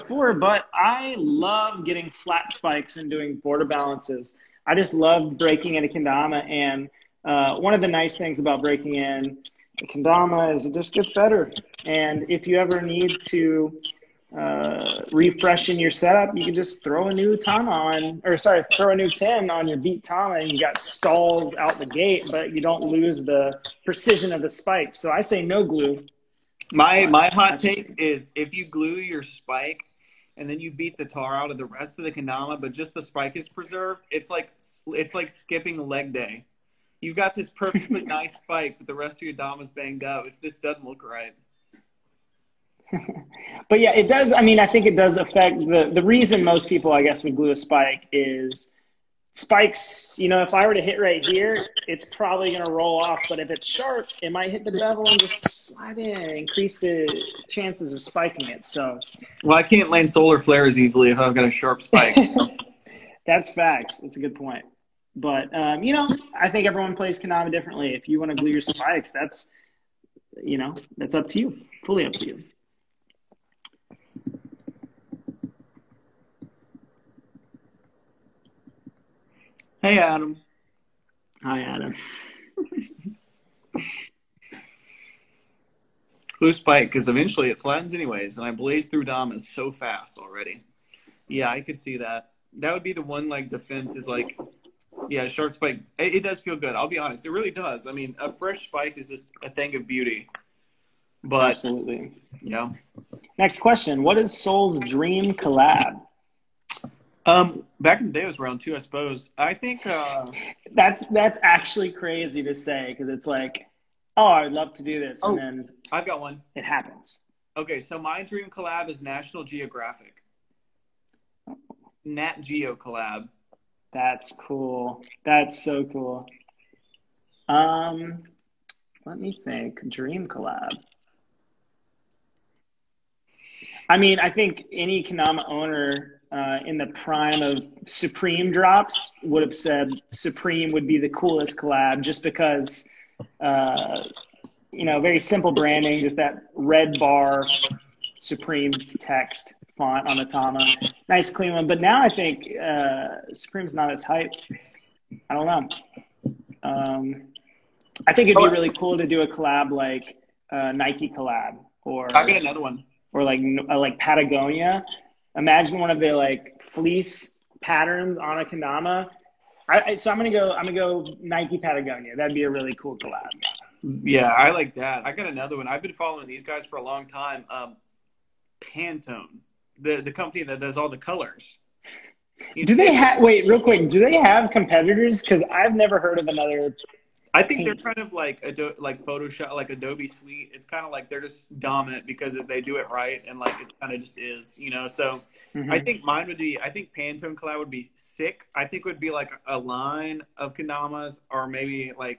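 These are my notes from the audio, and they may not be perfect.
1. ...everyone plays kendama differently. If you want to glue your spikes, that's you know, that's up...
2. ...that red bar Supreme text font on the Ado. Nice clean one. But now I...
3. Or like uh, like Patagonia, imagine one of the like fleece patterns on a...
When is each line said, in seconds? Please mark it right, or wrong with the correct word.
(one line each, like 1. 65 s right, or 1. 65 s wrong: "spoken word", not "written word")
1. 66 s right
2. 146 s wrong: "Tama", not "Ado"
3. 163 s right.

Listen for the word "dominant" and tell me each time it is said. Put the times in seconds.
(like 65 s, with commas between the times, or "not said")
191 s.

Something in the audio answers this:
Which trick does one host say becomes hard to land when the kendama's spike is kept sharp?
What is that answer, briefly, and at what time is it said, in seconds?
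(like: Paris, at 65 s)
Solar flares, at 60 s.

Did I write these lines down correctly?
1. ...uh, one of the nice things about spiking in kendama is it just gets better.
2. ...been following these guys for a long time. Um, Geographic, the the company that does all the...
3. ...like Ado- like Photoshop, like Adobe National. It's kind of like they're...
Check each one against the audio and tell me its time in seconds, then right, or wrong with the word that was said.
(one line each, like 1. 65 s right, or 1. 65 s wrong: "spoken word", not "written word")
1. 7 s wrong: "breaking", not "spiking"
2. 175 s wrong: "Pantone", not "Geographic"
3. 188 s wrong: "Suite", not "National".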